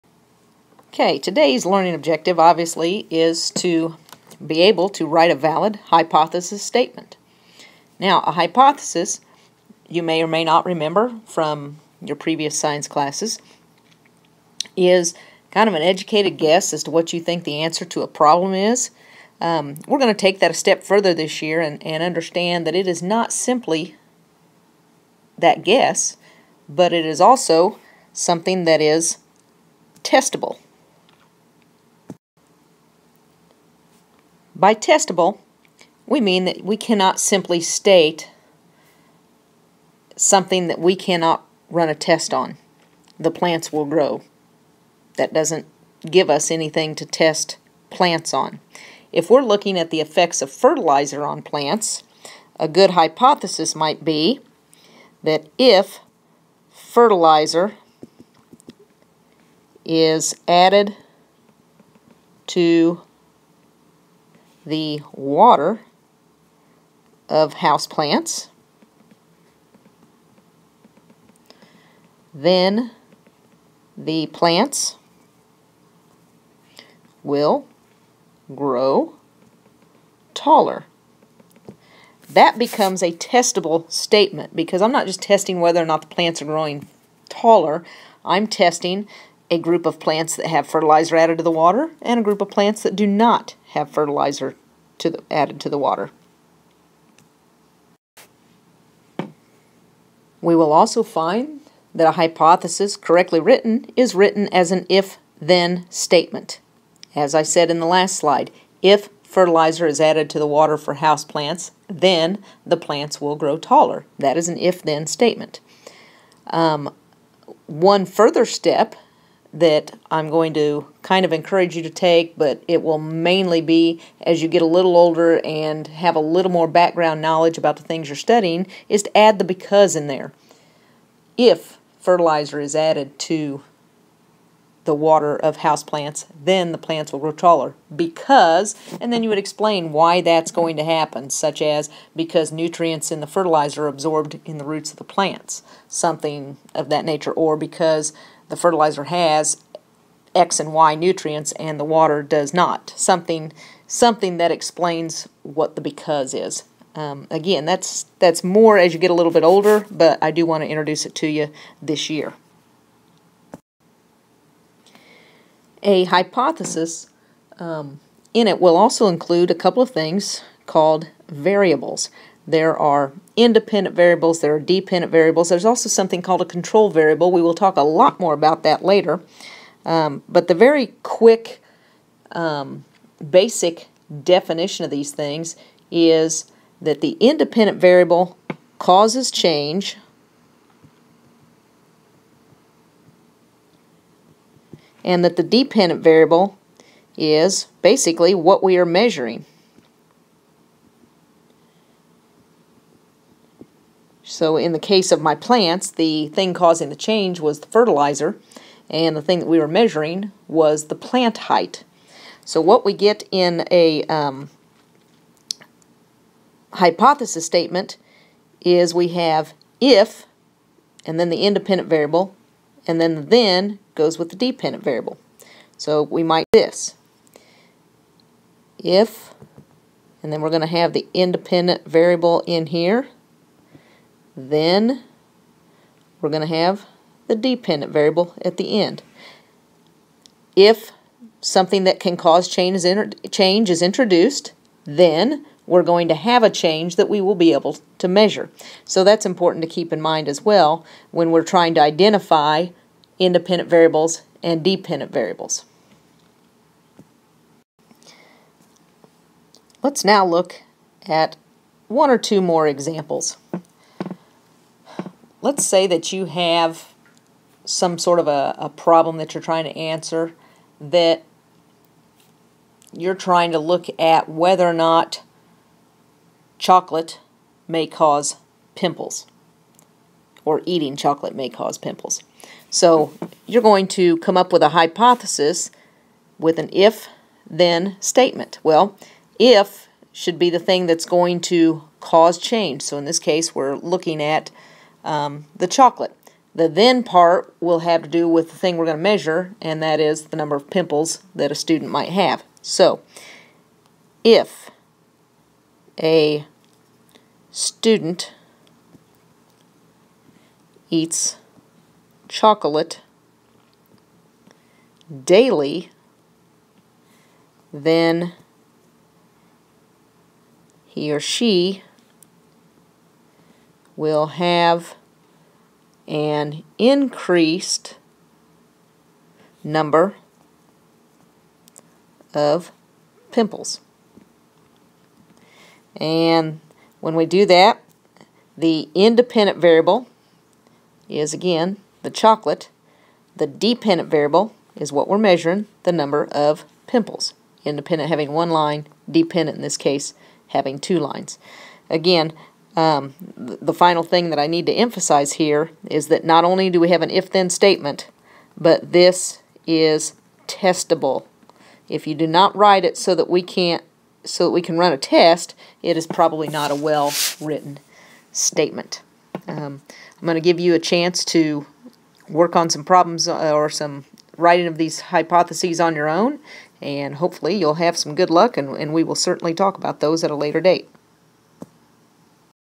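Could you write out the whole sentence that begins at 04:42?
So you're going to come up with a hypothesis with an if then statement.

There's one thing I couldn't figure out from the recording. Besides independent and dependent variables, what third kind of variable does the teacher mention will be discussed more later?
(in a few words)
control variable.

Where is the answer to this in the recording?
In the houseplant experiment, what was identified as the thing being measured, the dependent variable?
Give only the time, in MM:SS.
03:30.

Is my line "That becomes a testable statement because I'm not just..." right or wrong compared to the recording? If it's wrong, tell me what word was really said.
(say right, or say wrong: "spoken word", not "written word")
right.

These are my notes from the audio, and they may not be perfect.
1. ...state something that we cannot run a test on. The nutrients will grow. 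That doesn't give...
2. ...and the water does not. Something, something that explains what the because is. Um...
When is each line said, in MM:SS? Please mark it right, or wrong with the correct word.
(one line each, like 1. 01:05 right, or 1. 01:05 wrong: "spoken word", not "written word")
1. 00:37 wrong: "plants", not "nutrients"
2. 02:31 right.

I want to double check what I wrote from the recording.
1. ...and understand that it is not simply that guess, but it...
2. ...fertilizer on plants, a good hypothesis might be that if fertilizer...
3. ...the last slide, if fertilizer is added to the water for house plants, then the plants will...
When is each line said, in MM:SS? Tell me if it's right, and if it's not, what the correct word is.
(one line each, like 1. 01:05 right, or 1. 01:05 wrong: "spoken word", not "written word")
1. 00:21 right
2. 00:50 right
3. 01:47 right.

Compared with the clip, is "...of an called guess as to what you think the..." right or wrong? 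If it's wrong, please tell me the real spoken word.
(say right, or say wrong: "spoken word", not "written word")
wrong: "educated", not "called".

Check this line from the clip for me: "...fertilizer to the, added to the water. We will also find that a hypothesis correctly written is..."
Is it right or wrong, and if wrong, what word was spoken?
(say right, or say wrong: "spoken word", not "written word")
right.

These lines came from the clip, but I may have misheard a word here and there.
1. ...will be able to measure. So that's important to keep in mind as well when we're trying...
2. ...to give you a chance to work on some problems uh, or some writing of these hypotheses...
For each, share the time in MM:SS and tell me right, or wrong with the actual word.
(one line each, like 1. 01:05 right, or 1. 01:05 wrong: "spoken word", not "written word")
1. 04:07 right
2. 06:10 right.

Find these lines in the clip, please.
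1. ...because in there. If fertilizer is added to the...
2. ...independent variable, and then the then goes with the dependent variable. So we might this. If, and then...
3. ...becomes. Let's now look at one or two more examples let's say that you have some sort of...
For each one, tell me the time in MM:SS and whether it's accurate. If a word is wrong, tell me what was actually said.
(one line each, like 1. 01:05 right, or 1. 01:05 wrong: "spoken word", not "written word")
1. 02:09 right
2. 03:41 right
3. 04:15 wrong: "variables", not "becomes".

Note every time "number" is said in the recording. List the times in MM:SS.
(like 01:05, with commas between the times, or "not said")
05:00, 05:29, 05:45.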